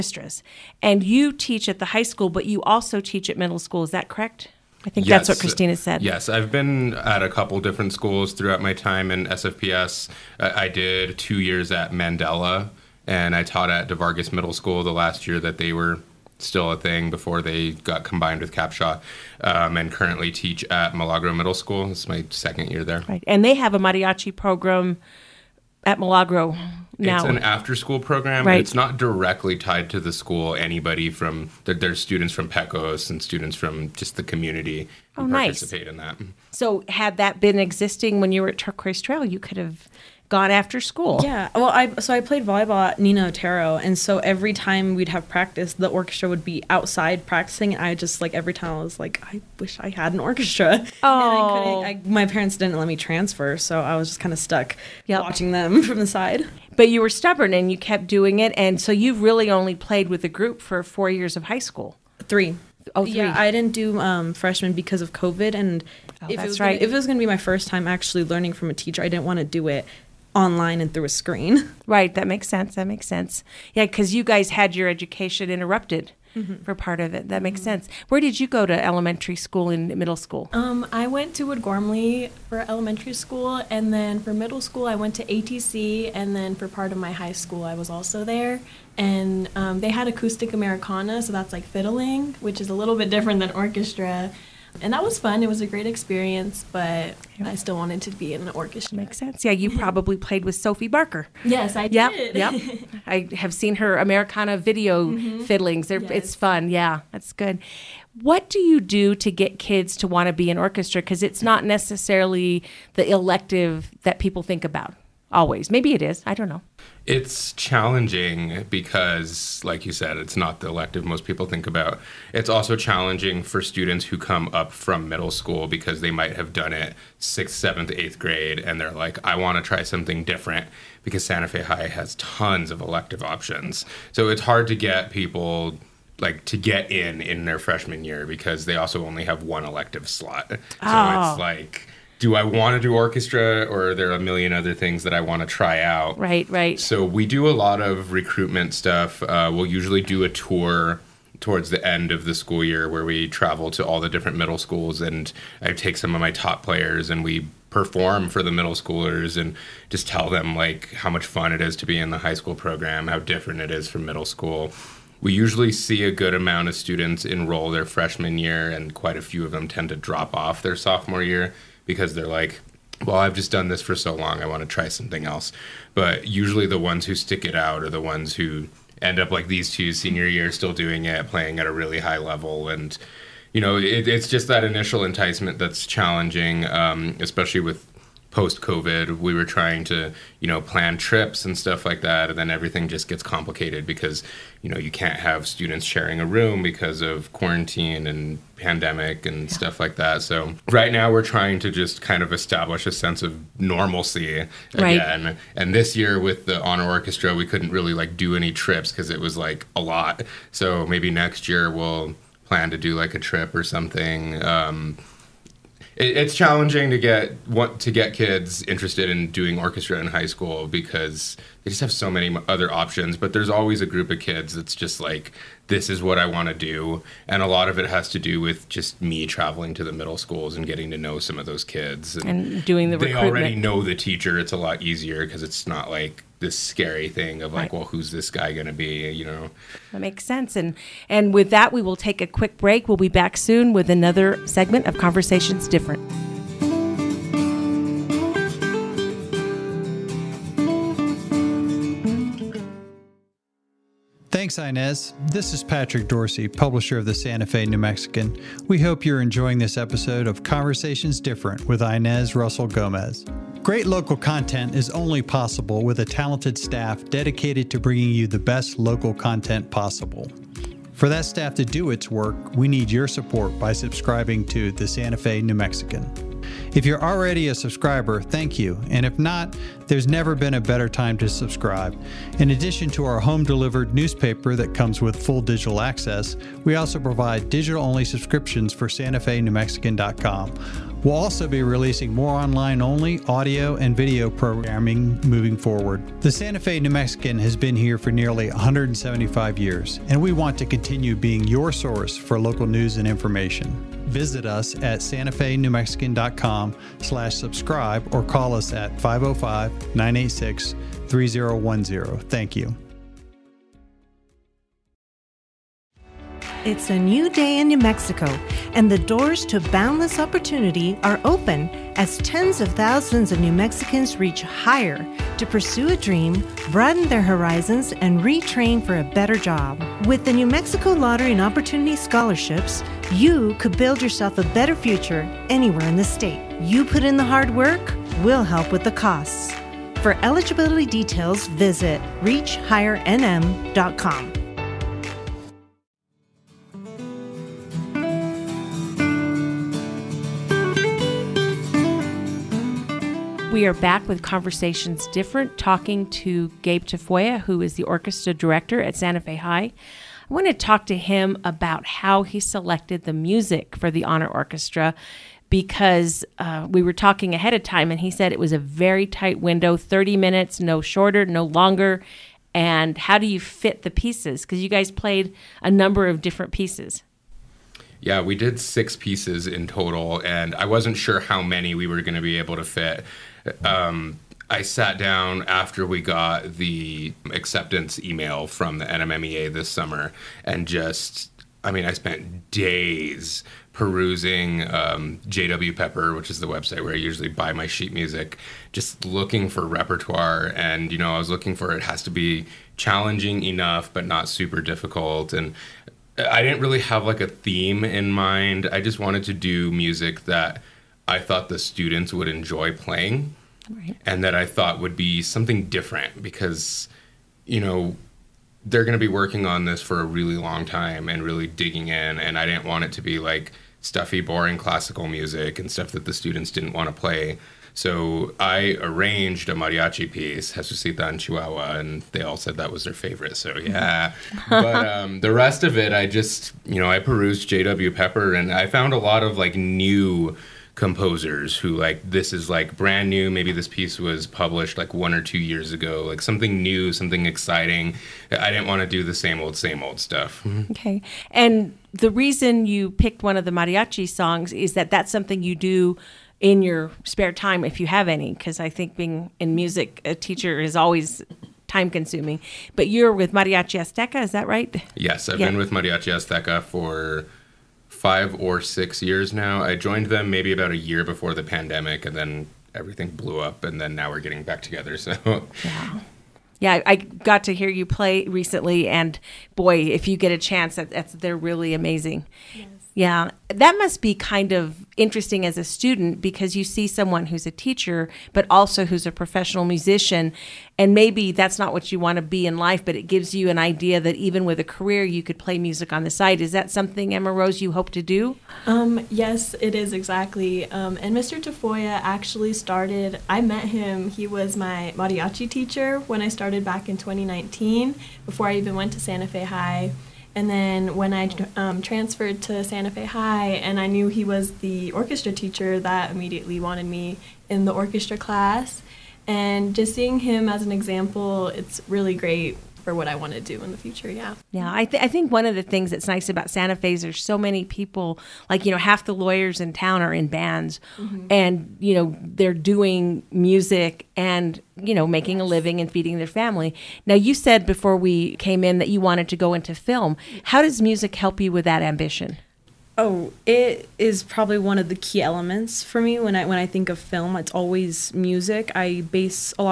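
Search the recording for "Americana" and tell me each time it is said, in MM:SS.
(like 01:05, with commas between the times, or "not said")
01:30, 01:43.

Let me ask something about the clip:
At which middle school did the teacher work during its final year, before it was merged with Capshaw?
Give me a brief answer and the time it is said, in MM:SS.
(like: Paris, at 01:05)
DeVargas Middle School, at 00:13.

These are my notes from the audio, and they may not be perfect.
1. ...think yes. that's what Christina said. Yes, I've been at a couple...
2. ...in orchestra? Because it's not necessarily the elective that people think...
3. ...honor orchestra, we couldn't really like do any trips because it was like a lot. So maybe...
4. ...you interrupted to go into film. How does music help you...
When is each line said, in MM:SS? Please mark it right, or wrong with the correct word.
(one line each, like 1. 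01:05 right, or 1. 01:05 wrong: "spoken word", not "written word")
1. 00:04 right
2. 01:50 right
3. 03:26 right
4. 08:58 wrong: "wanted", not "interrupted".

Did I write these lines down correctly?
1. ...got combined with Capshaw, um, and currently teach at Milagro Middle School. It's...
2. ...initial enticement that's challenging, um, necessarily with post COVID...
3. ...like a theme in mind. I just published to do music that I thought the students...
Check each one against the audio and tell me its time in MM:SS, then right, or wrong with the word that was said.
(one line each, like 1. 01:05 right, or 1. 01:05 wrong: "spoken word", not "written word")
1. 00:17 right
2. 03:04 wrong: "especially", not "necessarily"
3. 06:47 wrong: "wanted", not "published".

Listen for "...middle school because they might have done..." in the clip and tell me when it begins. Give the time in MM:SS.
02:05.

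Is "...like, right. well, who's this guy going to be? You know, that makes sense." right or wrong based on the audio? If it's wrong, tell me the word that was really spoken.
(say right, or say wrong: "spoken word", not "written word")
right.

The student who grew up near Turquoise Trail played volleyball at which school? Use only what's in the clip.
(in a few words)
Nina Otero.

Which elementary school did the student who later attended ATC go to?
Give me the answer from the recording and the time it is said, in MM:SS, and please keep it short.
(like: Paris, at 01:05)
Wood Gormley, at 01:21.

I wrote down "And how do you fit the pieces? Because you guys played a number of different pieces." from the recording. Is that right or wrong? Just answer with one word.
right.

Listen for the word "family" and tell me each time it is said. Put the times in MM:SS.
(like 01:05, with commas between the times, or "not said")
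08:56.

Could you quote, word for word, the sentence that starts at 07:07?
So I arranged a mariachi piece, Jesusita en Chihuahua, and they all said that was their favorite.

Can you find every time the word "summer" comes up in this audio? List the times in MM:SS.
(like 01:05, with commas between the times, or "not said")
06:29.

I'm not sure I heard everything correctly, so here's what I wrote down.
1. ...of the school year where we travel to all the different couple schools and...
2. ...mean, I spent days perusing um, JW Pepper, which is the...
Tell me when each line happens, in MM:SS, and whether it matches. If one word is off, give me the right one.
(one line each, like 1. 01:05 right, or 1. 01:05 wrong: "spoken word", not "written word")
1. 02:32 wrong: "middle", not "couple"
2. 06:31 right.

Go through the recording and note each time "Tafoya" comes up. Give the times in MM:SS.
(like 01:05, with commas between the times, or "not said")
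05:56, 08:21.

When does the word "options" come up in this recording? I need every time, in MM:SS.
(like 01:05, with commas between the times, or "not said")
02:13, 03:42.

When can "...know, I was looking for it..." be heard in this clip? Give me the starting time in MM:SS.
06:40.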